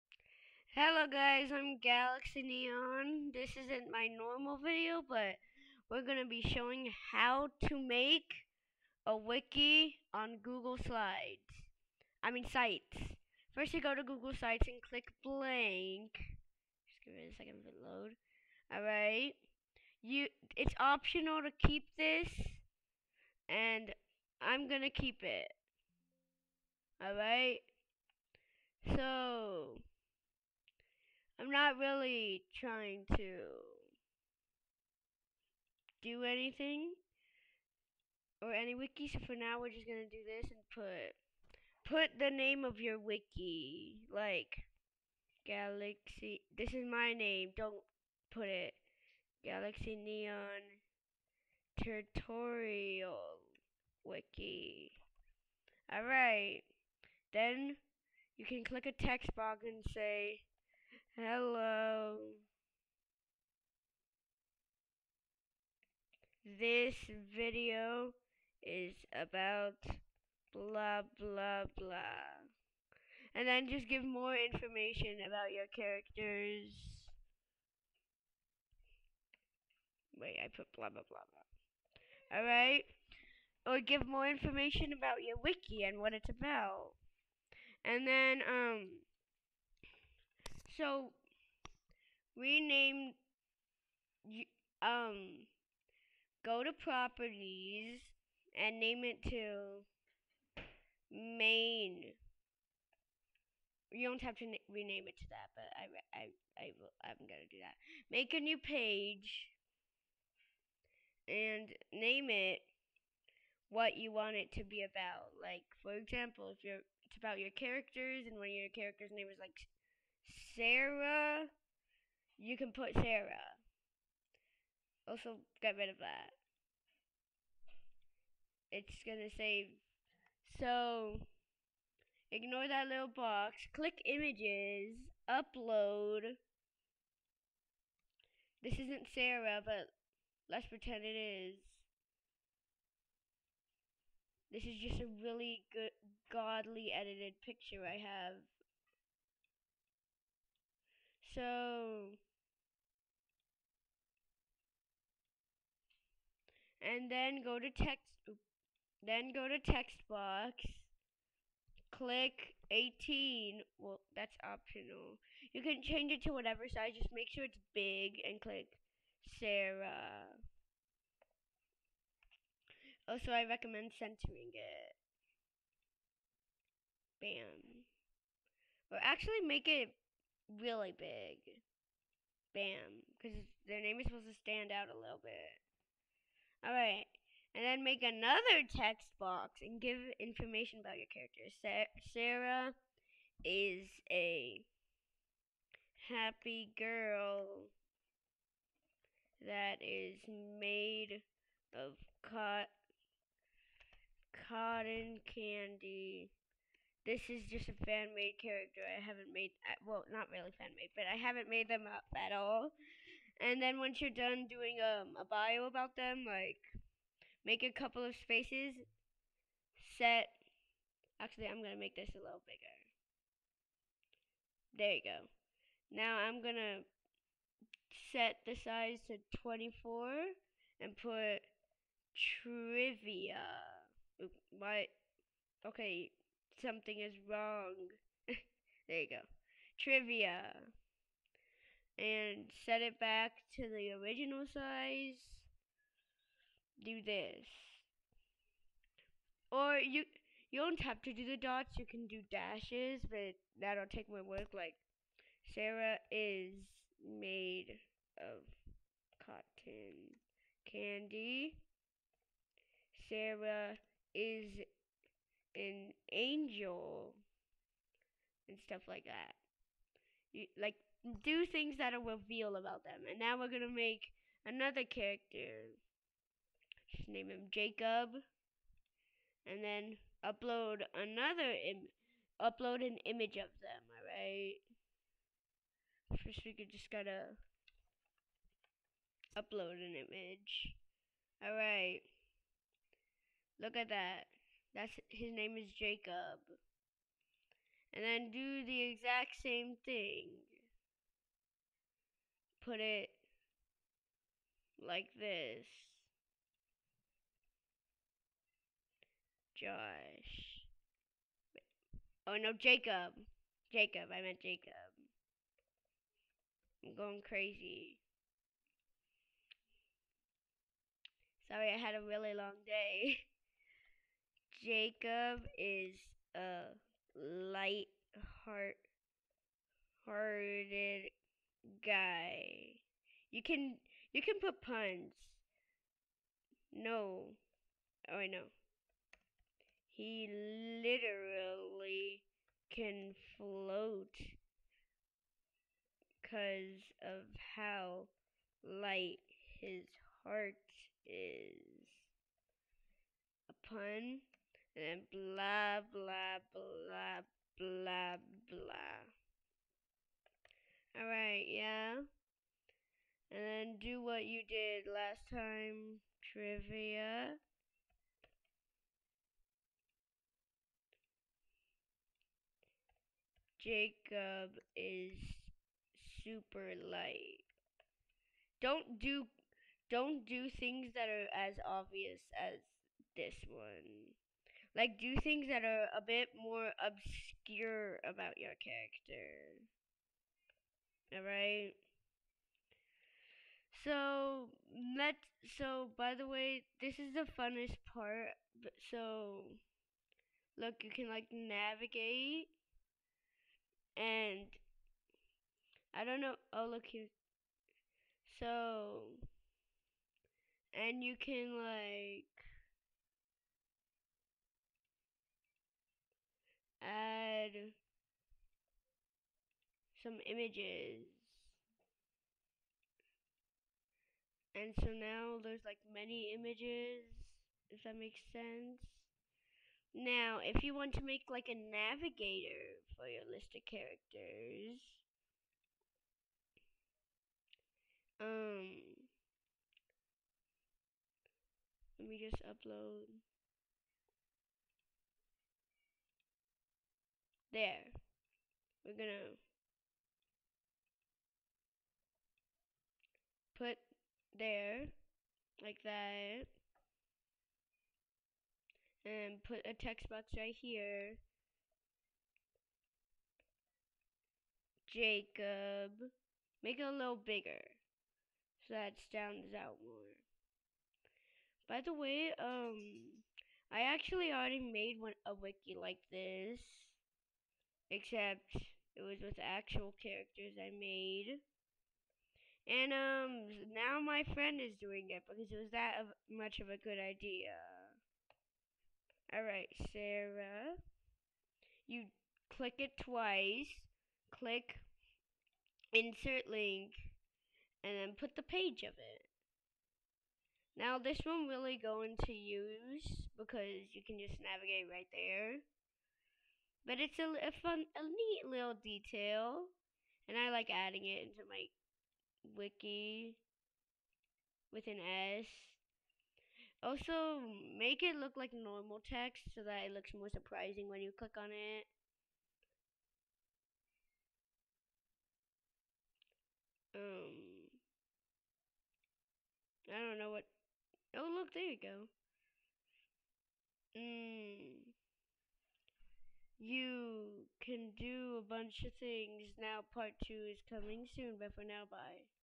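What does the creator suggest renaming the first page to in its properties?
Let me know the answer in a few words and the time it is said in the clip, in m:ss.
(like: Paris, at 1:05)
main, at 1:41.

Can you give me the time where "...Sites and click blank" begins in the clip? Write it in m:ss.
0:14.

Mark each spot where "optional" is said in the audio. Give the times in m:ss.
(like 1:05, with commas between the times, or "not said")
0:20, 2:44.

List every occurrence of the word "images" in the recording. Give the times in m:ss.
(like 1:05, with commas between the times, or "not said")
2:14, 4:43, 4:49, 7:00, 7:06.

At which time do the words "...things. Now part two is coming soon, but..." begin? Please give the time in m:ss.
8:59.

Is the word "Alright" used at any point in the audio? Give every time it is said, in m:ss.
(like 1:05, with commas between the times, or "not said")
0:18, 0:27, 1:22, 3:06, 6:00.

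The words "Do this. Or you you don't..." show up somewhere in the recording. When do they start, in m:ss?
4:06.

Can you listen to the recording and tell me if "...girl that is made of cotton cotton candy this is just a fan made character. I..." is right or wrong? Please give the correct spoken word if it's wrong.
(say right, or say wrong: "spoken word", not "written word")
right.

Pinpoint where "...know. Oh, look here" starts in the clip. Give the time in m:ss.
6:46.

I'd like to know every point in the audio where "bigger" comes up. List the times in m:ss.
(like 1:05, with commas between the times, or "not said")
3:42, 7:47.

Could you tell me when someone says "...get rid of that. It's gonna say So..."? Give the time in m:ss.
2:05.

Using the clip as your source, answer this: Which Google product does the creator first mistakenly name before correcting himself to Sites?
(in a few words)
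Google Slides.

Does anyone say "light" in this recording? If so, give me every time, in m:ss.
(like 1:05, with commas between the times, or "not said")
5:27, 5:48, 6:16.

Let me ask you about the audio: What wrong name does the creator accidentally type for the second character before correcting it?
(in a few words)
Josh.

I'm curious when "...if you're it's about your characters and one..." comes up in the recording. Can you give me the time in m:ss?
1:56.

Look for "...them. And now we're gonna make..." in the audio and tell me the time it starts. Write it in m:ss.
4:32.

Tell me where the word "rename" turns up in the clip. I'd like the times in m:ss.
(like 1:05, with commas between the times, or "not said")
1:32, 1:44.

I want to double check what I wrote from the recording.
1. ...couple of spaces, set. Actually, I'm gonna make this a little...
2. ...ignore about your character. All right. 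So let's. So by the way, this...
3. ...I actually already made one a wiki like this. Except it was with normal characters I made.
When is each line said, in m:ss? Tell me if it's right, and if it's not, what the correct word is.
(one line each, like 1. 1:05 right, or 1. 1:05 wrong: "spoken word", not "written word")
1. 3:37 right
2. 6:26 wrong: "obscure", not "ignore"
3. 7:53 wrong: "actual", not "normal".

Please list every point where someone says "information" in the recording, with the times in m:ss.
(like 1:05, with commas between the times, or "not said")
1:14, 1:24, 3:10.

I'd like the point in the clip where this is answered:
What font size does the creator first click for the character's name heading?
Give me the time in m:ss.
2:42.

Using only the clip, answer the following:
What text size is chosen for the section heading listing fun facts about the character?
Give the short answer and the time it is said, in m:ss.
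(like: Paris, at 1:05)
24, at 3:49.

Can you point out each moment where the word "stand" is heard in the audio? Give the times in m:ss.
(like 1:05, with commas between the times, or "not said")
3:04, 7:49.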